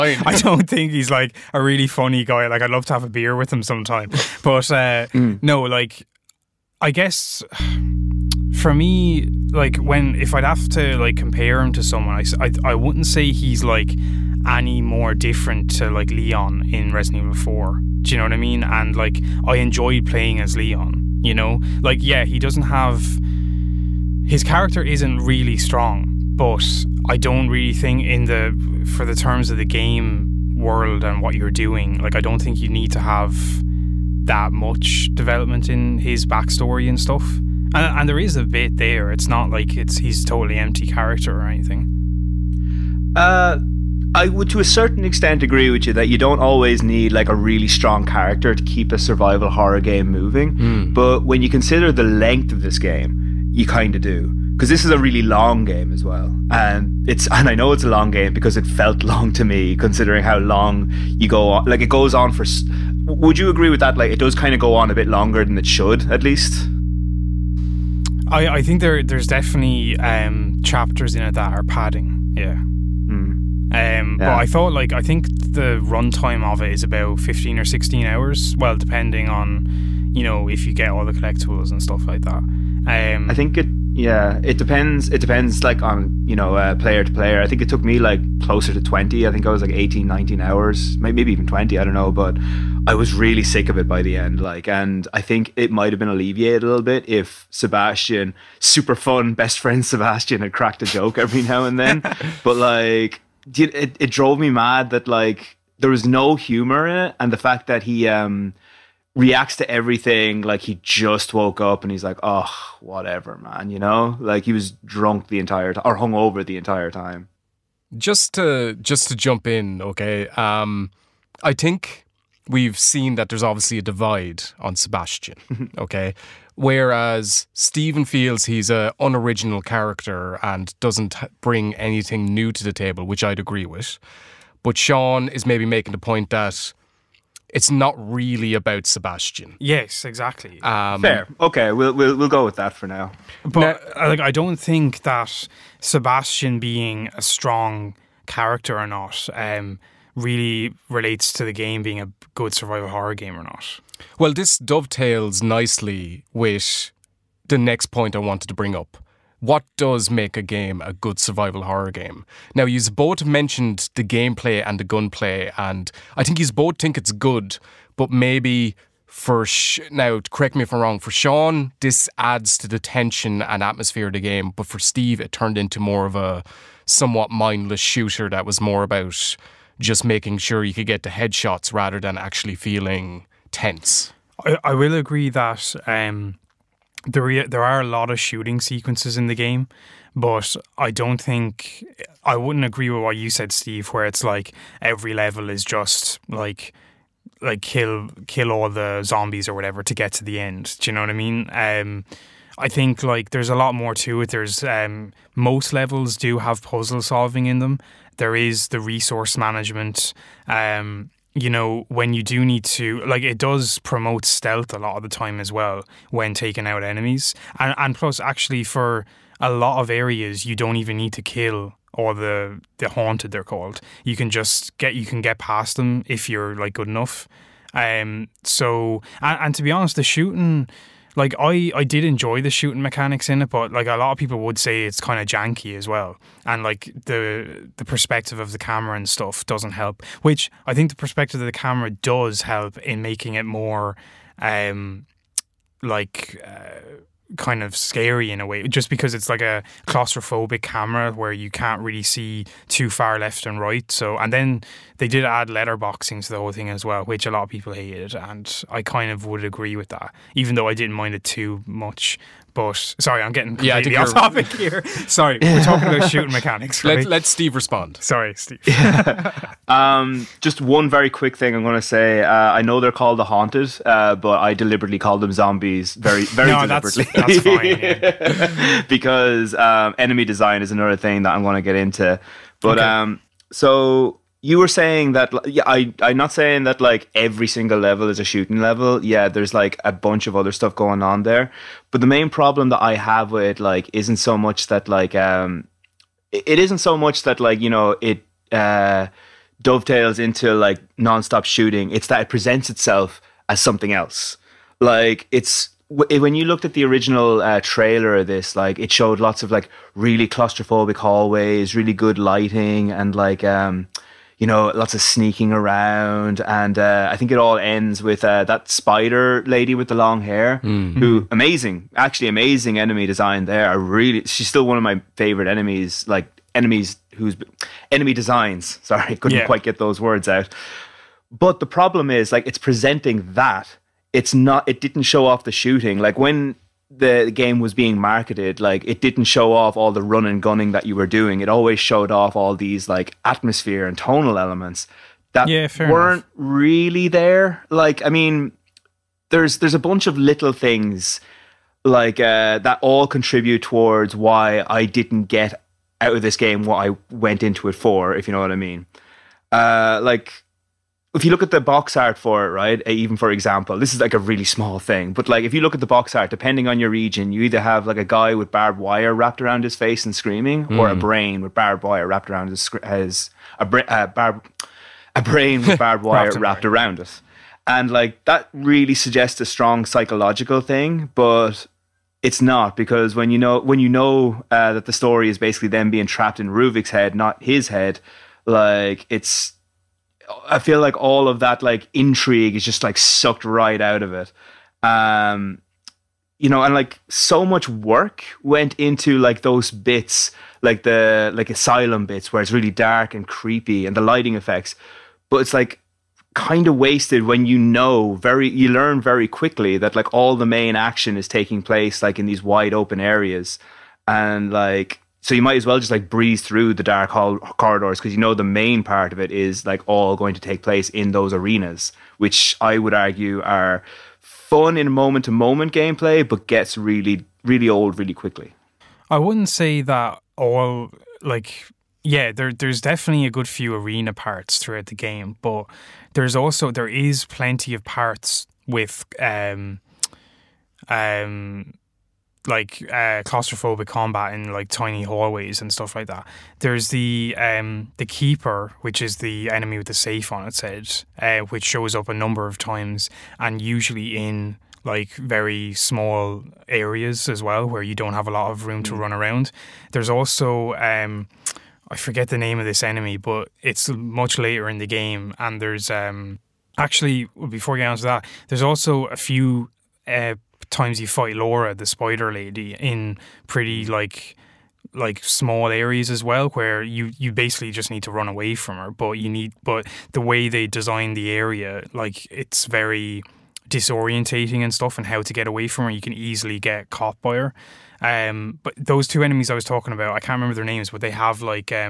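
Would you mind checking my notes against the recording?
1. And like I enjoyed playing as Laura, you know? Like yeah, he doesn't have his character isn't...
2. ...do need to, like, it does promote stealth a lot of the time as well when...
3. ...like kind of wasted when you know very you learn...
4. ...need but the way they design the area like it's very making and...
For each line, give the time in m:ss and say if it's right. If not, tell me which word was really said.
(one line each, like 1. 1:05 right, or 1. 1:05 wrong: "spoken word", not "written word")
1. 0:18 wrong: "Leon", not "Laura"
2. 3:32 right
3. 6:45 right
4. 7:59 wrong: "disorientating", not "making".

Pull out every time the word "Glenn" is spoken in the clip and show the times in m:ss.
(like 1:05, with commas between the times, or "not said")
not said.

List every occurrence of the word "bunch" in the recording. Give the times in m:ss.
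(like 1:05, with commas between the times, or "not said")
4:49, 5:49.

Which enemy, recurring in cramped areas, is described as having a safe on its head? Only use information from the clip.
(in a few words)
the Keeper.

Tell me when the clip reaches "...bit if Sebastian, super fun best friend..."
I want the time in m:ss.
1:36.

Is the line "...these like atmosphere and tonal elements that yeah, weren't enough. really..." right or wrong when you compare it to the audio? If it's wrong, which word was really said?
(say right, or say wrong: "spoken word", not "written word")
right.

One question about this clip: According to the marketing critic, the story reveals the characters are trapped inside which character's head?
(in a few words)
Ruvik.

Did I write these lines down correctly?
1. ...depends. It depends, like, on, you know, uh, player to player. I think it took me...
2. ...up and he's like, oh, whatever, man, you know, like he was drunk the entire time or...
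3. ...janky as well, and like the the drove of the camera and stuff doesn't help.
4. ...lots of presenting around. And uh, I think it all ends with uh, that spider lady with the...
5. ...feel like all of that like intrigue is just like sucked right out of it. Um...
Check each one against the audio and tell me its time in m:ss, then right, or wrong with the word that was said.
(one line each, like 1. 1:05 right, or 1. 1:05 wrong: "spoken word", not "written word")
1. 1:24 right
2. 1:51 right
3. 3:55 wrong: "perspective", not "drove"
4. 5:14 wrong: "sneaking", not "presenting"
5. 6:30 right.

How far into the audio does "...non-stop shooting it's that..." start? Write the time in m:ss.
5:00.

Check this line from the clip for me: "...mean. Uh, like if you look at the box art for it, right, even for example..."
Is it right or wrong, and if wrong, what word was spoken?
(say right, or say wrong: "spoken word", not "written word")
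right.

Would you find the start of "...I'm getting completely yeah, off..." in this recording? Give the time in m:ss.
4:23.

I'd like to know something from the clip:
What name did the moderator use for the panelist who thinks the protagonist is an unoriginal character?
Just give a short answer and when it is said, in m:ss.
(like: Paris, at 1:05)
Stephen, at 2:07.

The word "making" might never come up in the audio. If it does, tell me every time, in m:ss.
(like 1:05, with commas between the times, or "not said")
2:15, 3:00, 4:03.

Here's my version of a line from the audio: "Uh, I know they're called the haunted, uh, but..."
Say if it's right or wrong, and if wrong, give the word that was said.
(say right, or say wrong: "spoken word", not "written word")
right.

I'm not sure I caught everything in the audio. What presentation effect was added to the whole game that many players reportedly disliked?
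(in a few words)
letterboxing.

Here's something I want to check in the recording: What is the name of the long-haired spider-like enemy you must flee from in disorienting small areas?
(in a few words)
Laura.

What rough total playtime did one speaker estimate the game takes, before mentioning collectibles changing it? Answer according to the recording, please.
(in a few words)
15 or 16 hours.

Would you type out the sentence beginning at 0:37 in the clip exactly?
And, and there is a bit there.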